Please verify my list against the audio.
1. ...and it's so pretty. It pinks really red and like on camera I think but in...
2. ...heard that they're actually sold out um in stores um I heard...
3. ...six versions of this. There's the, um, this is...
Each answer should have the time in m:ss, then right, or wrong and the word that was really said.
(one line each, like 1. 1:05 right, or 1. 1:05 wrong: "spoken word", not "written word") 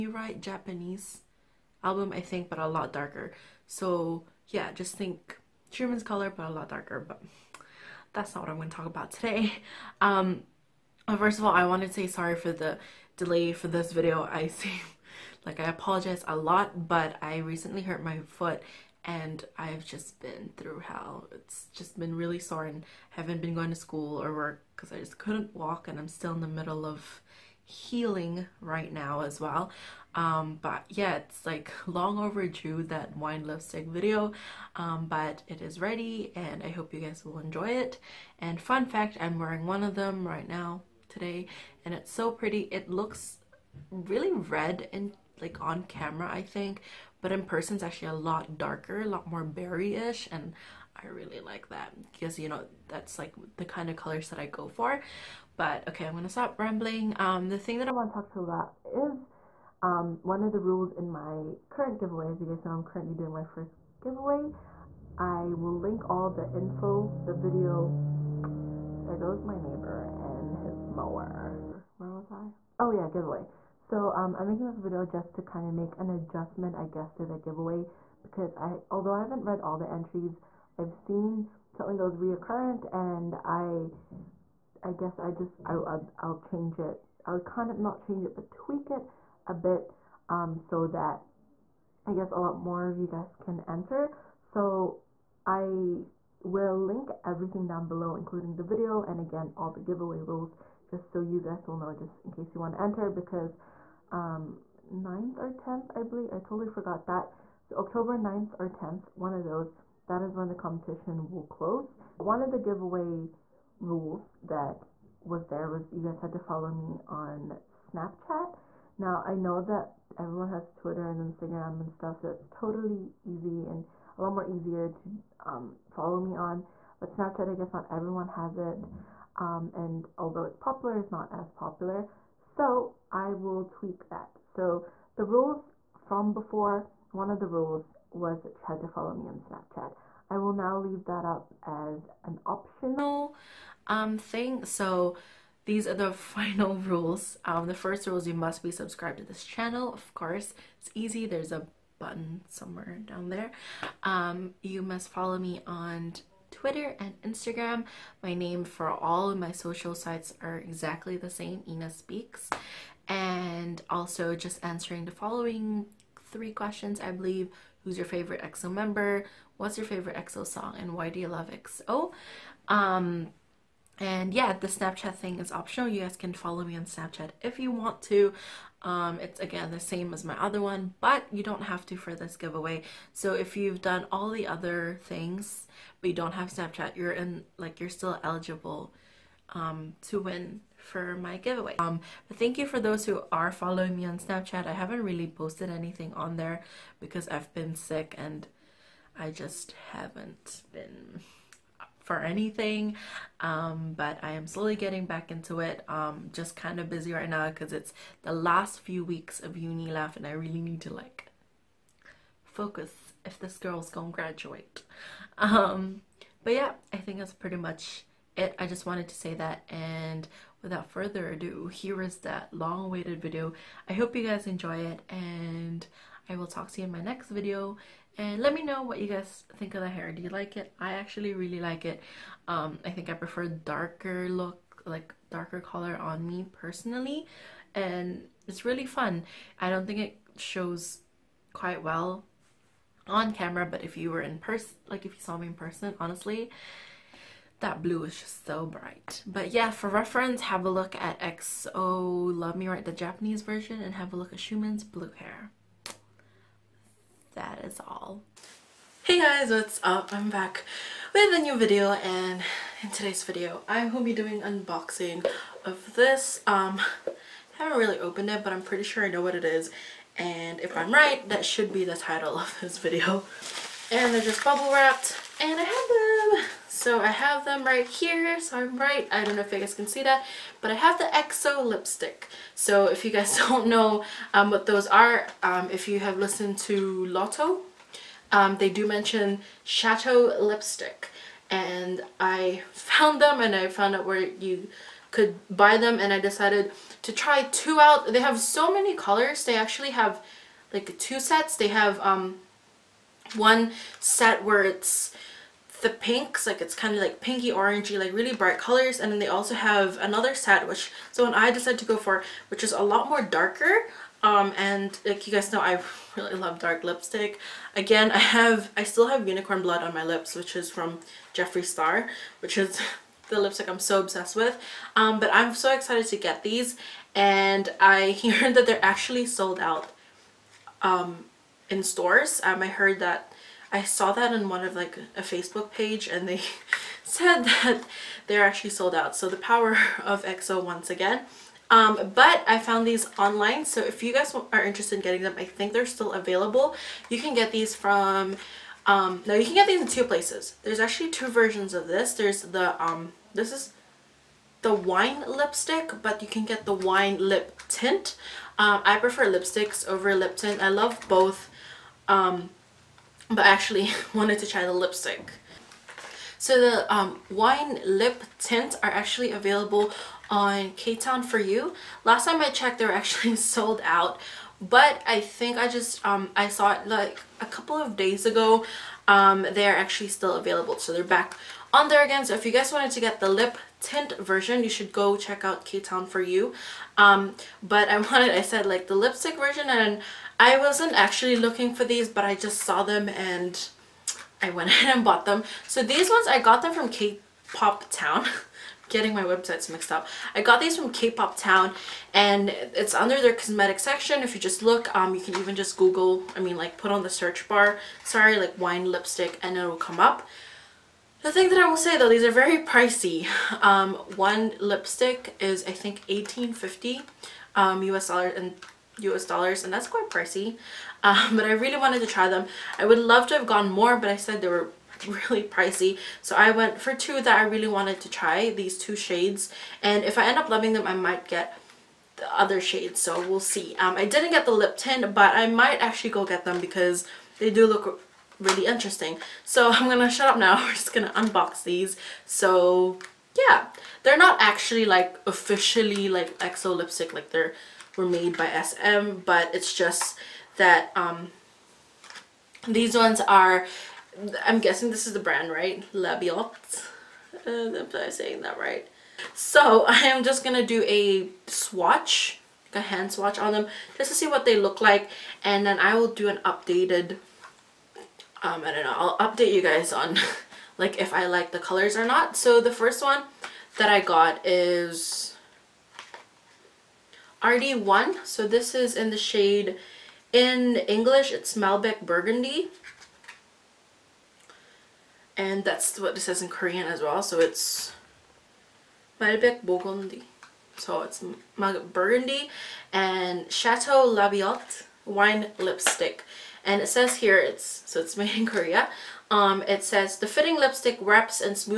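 1. 0:41 wrong: "looks", not "pinks"
2. 5:28 right
3. 5:51 wrong: "two", not "six".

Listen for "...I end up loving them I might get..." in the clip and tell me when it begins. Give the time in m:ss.
7:10.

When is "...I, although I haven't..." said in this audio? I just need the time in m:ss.
1:18.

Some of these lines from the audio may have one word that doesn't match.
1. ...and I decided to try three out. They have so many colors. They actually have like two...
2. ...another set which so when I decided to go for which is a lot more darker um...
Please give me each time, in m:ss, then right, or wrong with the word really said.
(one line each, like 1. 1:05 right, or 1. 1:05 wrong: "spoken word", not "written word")
1. 4:55 wrong: "two", not "three"
2. 5:09 right.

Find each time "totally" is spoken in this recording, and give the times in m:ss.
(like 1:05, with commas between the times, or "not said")
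1:46, 2:02.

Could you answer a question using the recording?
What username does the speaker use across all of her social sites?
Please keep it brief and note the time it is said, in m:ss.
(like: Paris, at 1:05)
Yna Speaks, at 2:41.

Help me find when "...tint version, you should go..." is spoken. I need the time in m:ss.
6:23.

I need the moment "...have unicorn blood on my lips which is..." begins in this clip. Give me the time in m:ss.
5:19.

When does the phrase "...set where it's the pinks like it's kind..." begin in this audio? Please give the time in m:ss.
5:03.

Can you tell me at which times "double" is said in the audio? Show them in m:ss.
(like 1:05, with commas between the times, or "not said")
not said.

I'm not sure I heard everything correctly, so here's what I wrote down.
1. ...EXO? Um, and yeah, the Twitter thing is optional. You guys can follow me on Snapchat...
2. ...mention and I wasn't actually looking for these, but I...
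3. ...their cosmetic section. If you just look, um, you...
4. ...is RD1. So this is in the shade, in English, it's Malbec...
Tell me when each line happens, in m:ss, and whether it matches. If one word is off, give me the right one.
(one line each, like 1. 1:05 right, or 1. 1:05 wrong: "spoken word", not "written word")
1. 2:51 wrong: "Snapchat", not "Twitter"
2. 6:29 wrong: "version", not "mention"
3. 6:43 right
4. 7:54 right.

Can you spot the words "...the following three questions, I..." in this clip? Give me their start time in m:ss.
2:45.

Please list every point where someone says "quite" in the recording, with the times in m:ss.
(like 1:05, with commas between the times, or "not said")
4:01, 6:59.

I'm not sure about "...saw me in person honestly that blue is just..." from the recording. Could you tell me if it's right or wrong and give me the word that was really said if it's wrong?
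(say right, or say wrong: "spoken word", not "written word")
right.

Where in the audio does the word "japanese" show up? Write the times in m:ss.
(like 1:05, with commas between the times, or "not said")
0:00, 4:12.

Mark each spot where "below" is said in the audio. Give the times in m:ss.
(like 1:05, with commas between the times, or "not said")
1:37.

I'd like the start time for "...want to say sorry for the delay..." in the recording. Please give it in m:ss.
0:11.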